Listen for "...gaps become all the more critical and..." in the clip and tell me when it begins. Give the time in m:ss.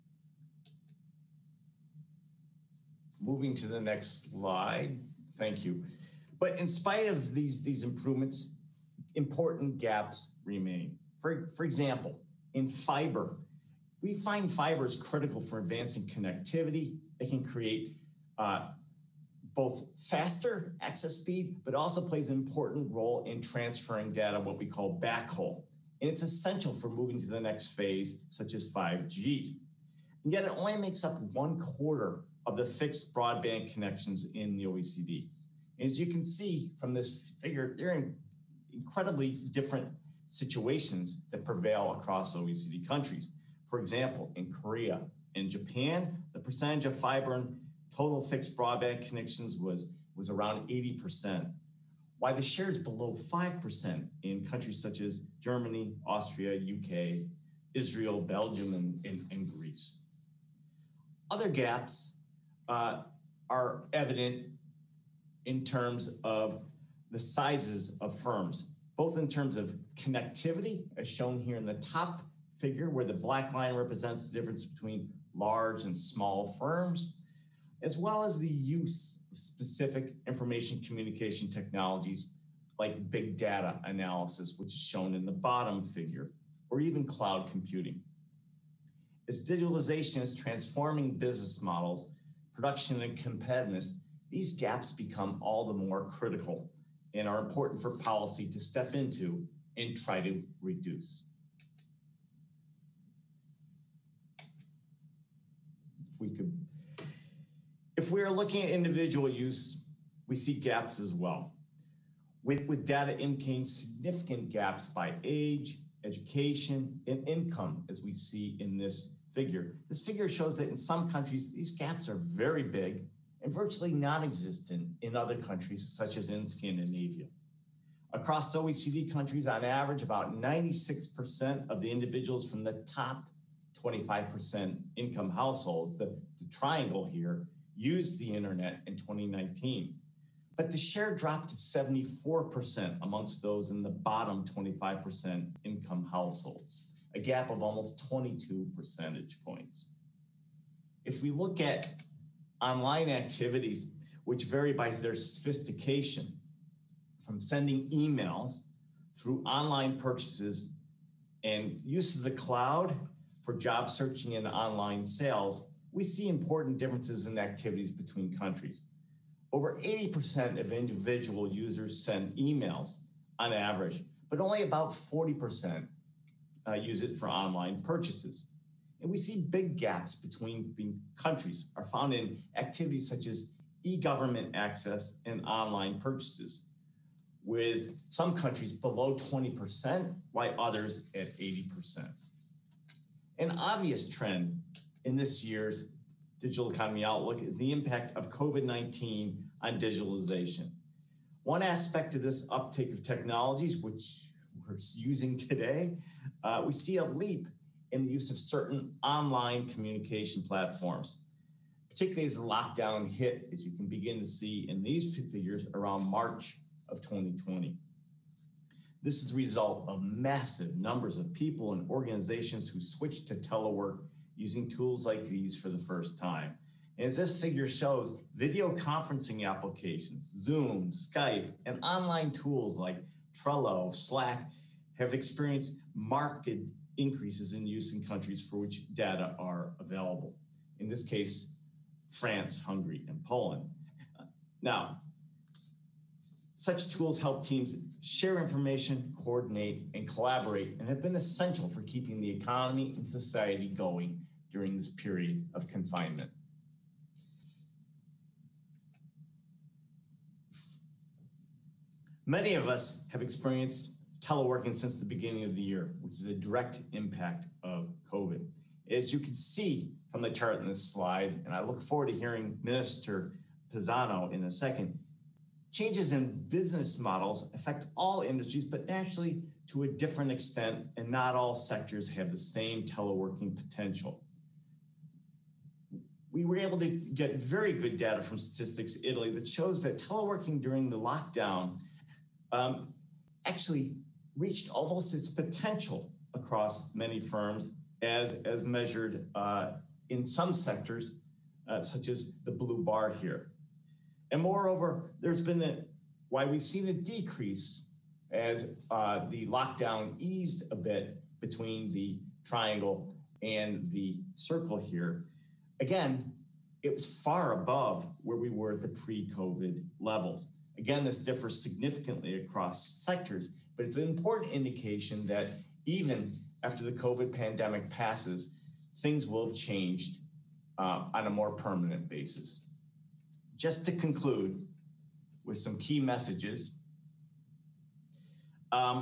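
1:34.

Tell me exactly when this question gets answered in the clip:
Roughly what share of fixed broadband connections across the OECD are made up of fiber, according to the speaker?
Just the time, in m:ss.
0:31.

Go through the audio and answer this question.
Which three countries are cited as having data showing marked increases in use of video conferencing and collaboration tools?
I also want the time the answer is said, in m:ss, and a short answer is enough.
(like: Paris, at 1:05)
France, Hungary, and Poland, at 4:02.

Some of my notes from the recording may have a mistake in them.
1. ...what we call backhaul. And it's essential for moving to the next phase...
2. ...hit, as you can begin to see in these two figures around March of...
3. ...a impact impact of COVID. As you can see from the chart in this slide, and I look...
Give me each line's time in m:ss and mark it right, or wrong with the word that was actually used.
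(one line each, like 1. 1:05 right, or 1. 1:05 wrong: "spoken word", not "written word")
1. 0:24 right
2. 3:33 right
3. 4:26 wrong: "direct", not "impact".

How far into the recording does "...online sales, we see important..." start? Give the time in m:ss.
2:44.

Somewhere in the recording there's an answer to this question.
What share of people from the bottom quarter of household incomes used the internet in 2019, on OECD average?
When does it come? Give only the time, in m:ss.
2:21.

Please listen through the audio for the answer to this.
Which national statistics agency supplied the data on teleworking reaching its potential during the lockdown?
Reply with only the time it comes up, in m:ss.
4:48.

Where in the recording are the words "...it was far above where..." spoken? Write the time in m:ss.
5:16.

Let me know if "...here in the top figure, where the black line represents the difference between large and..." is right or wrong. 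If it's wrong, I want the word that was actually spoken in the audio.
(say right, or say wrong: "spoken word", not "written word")
right.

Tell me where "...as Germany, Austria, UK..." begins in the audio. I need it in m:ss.
0:54.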